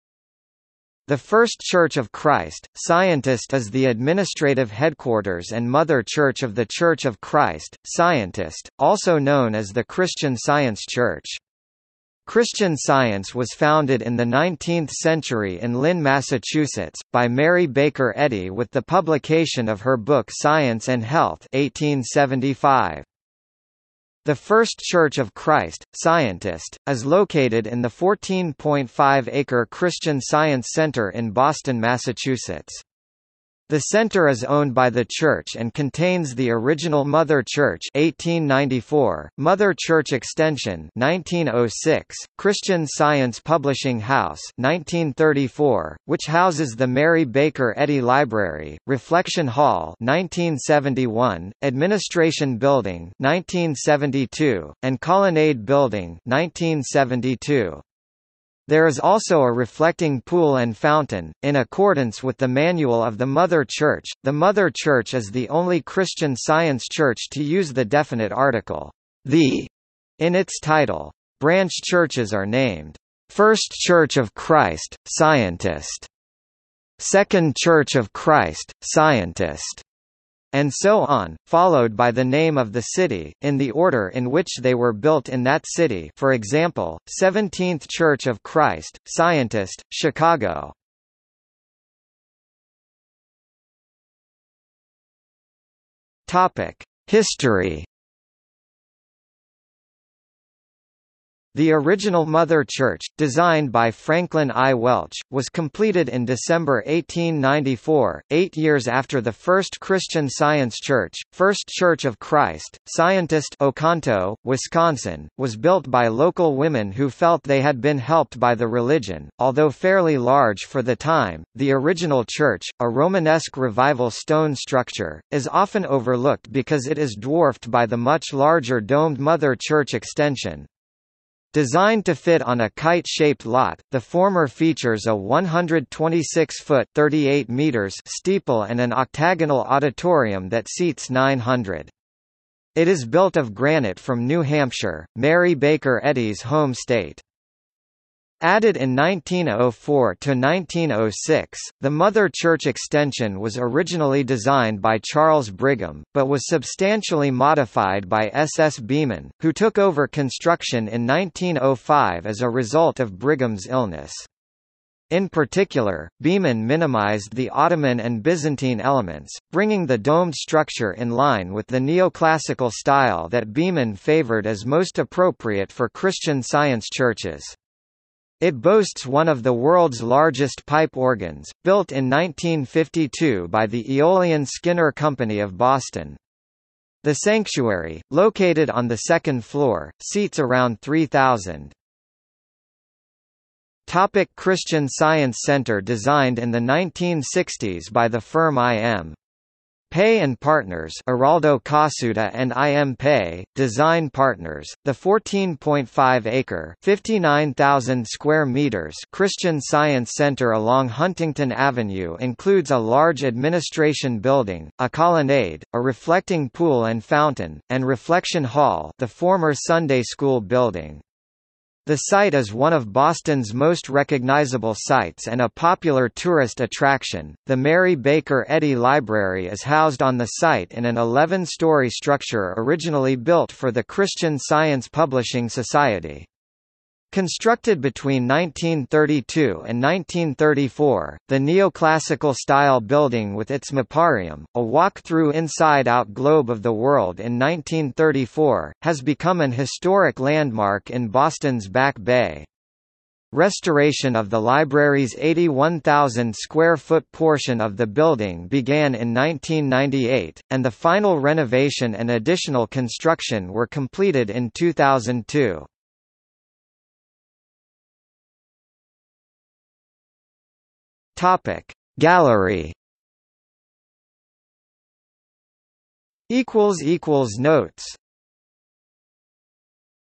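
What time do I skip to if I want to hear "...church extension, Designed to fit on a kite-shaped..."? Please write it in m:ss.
2:09.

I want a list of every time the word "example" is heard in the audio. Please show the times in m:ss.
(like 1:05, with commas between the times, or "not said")
1:26.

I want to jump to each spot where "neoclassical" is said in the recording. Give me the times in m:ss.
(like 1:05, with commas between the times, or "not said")
2:51, 4:01.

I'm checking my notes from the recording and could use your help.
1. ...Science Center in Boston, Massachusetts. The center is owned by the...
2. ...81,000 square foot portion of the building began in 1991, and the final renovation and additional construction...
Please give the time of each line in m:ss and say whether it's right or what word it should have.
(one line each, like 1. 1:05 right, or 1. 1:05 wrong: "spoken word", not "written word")
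1. 0:30 right
2. 4:15 wrong: "1998", not "1991".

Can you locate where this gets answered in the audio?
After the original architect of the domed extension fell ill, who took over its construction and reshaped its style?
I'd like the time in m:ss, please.
2:38.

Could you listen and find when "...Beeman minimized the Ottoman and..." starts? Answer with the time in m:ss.
2:46.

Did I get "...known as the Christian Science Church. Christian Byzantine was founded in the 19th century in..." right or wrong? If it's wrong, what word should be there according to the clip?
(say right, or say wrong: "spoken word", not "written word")
wrong: "Science", not "Byzantine".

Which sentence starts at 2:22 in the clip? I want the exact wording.
It is built of granite from New Hampshire, Mary Baker Eddy's home state.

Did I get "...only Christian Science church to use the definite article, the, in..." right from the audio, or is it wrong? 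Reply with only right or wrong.
right.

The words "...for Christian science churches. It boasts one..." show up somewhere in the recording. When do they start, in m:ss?
2:55.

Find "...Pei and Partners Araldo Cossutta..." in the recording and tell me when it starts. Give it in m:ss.
3:19.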